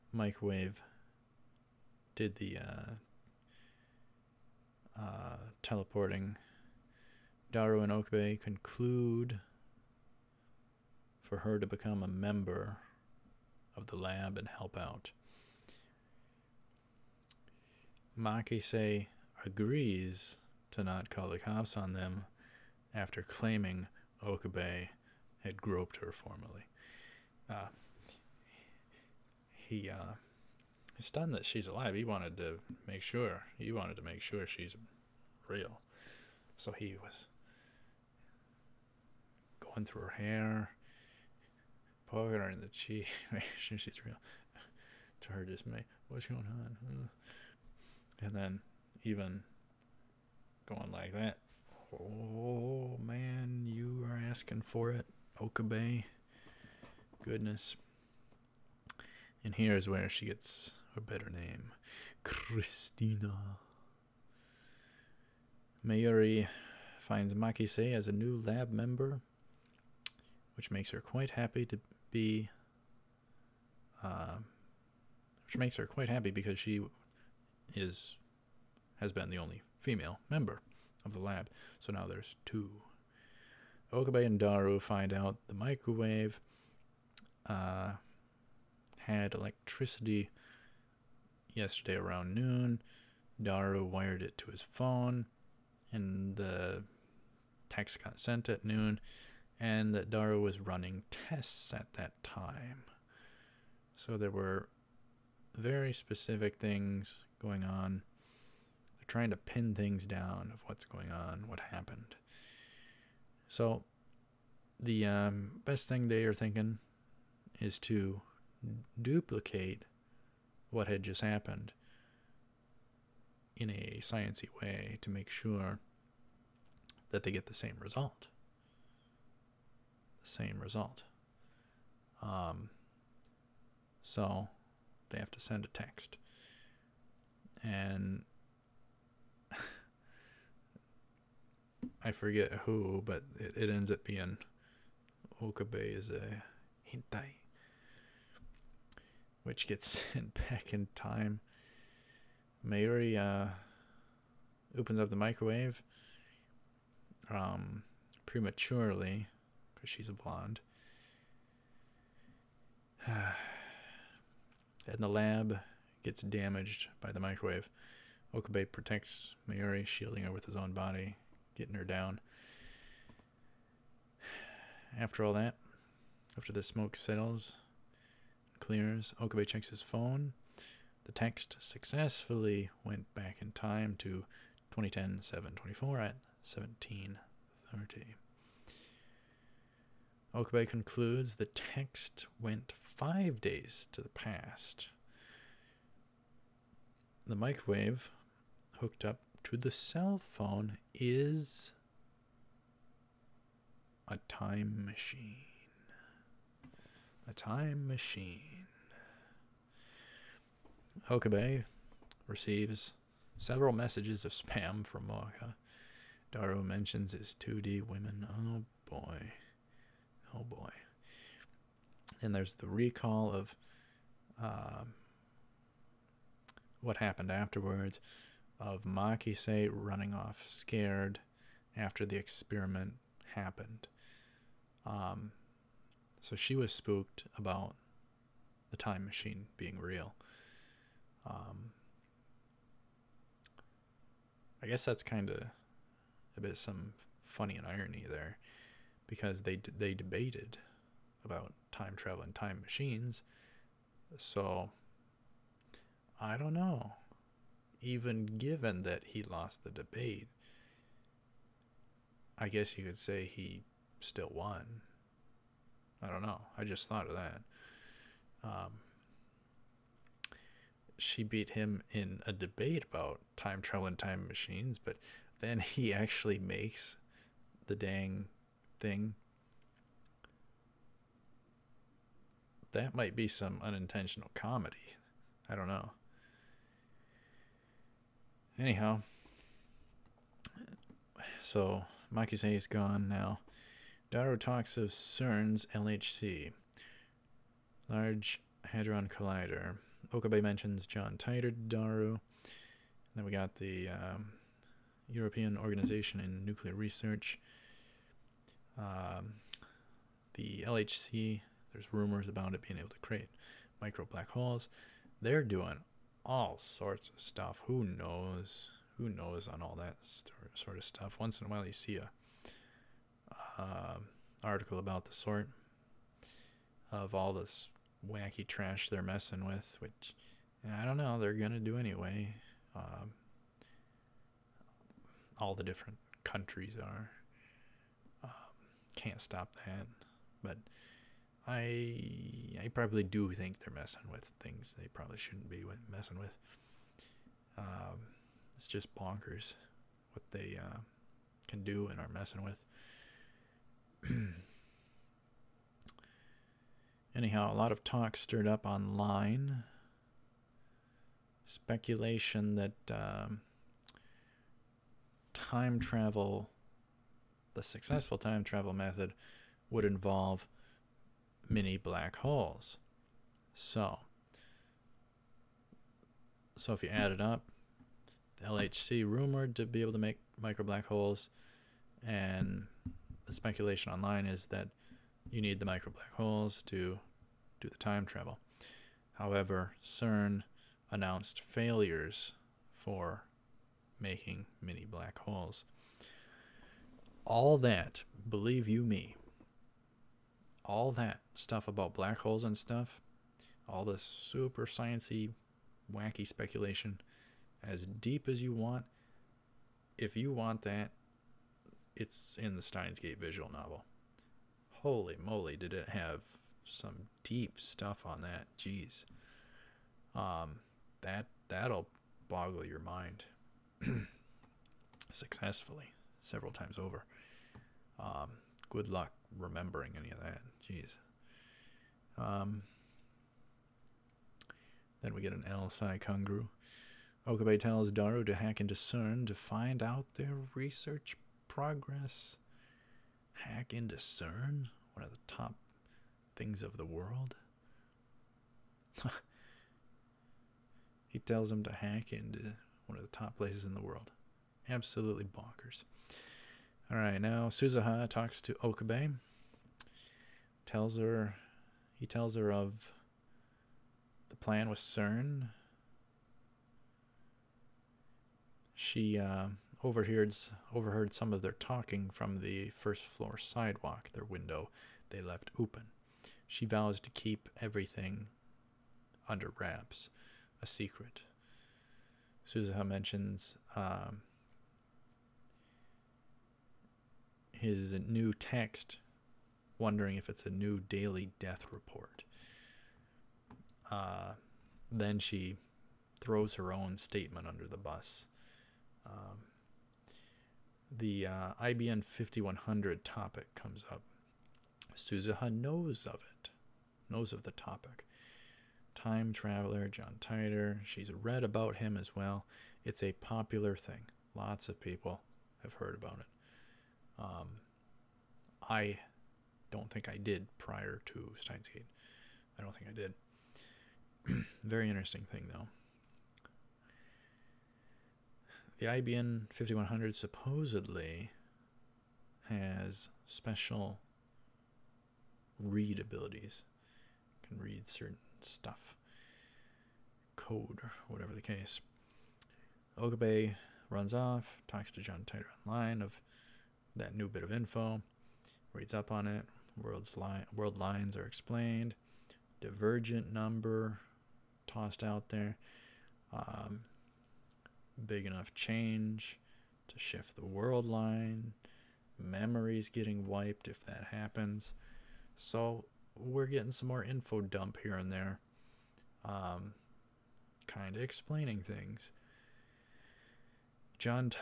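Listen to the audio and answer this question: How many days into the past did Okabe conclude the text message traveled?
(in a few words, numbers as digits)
5.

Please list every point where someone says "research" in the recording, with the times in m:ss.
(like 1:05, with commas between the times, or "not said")
5:06, 7:20.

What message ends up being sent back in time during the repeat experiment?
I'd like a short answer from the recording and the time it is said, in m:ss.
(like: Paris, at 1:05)
Okabe is a hentai, at 2:25.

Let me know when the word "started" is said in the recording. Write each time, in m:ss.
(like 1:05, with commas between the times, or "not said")
not said.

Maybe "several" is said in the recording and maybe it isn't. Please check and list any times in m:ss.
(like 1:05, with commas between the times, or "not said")
3:33, 7:06.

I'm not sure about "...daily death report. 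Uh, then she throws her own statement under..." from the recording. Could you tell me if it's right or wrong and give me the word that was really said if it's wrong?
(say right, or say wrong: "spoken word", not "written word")
right.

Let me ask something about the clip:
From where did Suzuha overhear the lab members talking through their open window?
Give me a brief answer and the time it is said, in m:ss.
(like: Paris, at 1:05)
first floor sidewalk, at 7:52.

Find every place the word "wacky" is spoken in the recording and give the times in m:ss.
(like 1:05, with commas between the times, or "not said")
5:28, 6:45.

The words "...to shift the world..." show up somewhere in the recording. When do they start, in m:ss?
9:19.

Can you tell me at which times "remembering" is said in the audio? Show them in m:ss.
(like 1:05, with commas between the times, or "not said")
7:09.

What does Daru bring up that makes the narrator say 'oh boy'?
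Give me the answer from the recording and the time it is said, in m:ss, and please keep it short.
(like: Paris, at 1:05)
his 2D women, at 3:37.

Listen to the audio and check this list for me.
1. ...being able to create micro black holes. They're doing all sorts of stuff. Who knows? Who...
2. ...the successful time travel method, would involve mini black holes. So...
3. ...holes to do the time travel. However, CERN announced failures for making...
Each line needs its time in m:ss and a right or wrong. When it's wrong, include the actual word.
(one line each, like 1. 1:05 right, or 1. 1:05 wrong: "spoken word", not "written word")
1. 5:12 right
2. 6:07 right
3. 6:26 right.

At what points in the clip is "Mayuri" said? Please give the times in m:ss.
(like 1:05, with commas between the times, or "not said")
1:05, 2:32, 2:49.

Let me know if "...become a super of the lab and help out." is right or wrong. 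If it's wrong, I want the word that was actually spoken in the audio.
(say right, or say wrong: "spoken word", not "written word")
wrong: "member", not "super".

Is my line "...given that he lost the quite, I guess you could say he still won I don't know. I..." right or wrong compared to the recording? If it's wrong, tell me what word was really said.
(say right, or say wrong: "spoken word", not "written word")
wrong: "debate", not "quite".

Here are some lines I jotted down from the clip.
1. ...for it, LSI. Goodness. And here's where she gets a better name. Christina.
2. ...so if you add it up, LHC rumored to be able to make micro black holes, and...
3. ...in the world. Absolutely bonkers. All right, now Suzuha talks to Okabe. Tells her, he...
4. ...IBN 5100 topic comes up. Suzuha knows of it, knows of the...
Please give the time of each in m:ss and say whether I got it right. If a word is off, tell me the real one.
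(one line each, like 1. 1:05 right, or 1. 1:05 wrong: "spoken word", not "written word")
1. 0:54 wrong: "Okabe", not "LSI"
2. 6:16 right
3. 7:33 right
4. 8:21 right.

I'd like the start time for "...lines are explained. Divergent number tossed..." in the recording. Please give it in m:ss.
9:10.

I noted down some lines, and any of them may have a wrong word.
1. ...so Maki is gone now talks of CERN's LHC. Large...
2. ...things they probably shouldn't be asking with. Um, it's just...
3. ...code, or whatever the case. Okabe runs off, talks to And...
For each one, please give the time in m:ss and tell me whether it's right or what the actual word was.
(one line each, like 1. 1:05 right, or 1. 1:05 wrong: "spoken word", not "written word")
1. 4:51 right
2. 5:44 wrong: "messing", not "asking"
3. 9:00 wrong: "John", not "And".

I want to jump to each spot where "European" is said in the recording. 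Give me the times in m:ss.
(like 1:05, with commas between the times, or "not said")
5:05.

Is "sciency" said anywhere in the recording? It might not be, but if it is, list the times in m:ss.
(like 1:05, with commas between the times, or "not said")
2:04, 6:44.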